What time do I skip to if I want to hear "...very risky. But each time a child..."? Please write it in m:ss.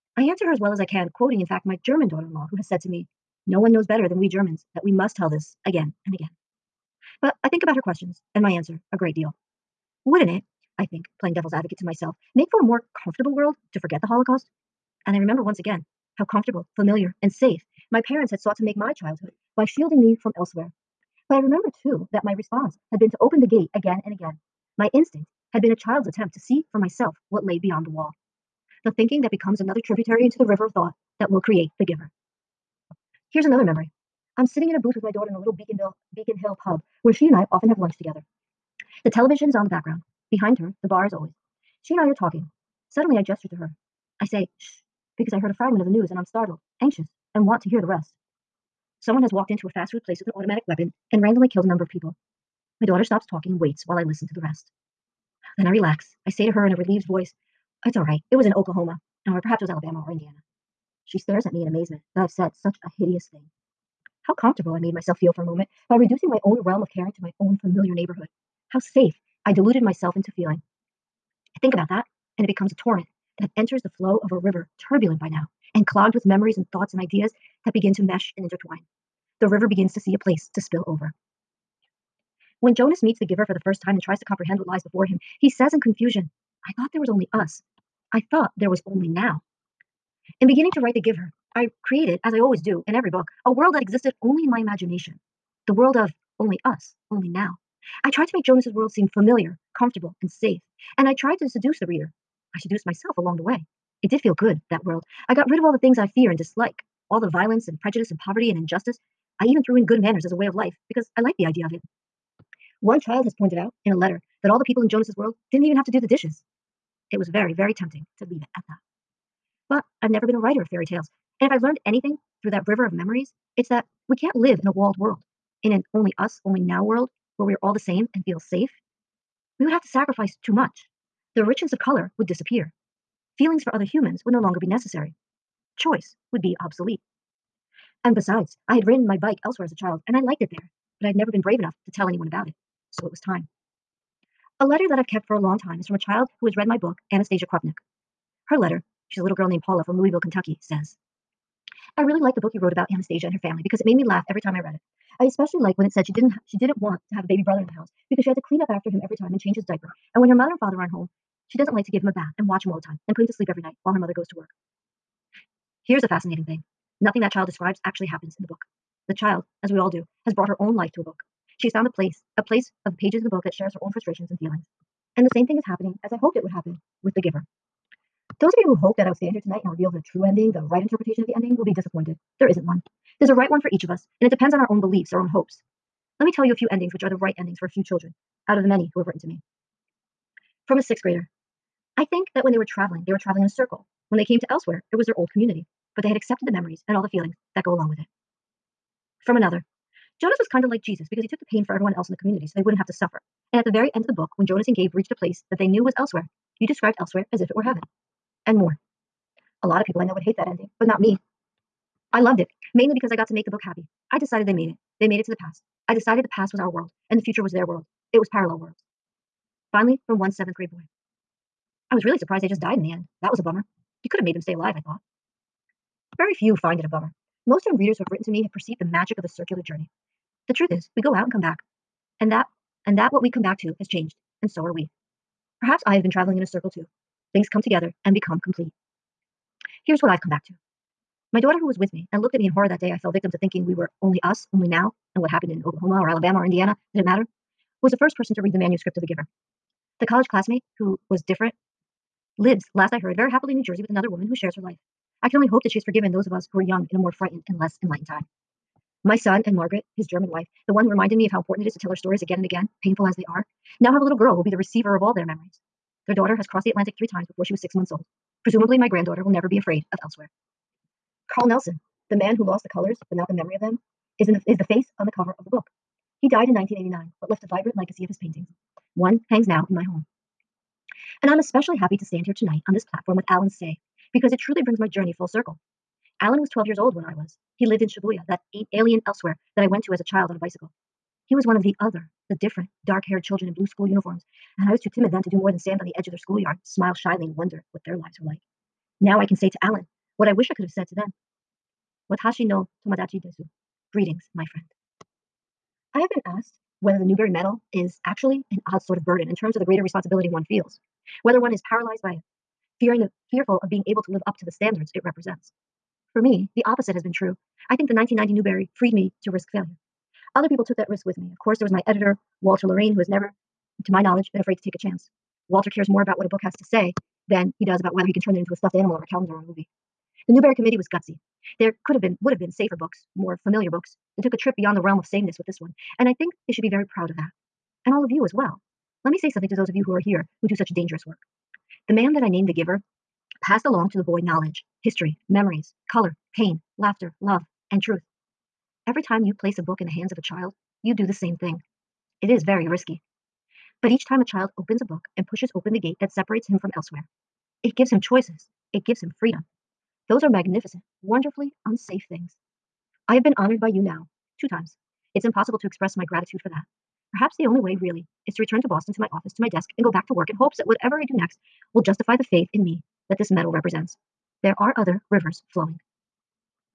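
5:52.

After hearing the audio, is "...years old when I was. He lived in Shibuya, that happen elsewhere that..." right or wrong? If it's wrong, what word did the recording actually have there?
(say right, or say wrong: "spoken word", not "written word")
wrong: "alien", not "happen".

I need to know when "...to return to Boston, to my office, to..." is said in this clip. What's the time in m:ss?
6:08.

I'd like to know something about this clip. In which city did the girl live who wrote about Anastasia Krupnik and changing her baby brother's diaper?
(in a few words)
Louisville, Kentucky.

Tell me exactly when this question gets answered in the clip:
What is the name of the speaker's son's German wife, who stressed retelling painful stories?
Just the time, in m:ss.
4:19.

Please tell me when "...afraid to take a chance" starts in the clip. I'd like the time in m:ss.
5:24.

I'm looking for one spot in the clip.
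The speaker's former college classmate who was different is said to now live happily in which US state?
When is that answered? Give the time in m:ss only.
4:13.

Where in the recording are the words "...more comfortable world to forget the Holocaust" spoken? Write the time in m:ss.
0:12.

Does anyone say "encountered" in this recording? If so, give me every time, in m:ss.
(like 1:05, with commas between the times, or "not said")
not said.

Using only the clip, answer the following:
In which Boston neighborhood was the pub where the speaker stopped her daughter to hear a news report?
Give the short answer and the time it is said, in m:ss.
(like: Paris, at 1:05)
Beacon Hill, at 0:36.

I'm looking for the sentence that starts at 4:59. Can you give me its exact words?
Now I can say to Allen what I wish I could have said to them.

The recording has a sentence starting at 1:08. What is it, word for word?
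How safe I deluded myself into feeling.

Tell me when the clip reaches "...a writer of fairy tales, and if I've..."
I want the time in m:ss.
2:00.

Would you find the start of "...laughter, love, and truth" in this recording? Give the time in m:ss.
5:46.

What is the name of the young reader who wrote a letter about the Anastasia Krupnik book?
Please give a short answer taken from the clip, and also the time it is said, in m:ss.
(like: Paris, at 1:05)
Paula, at 2:29.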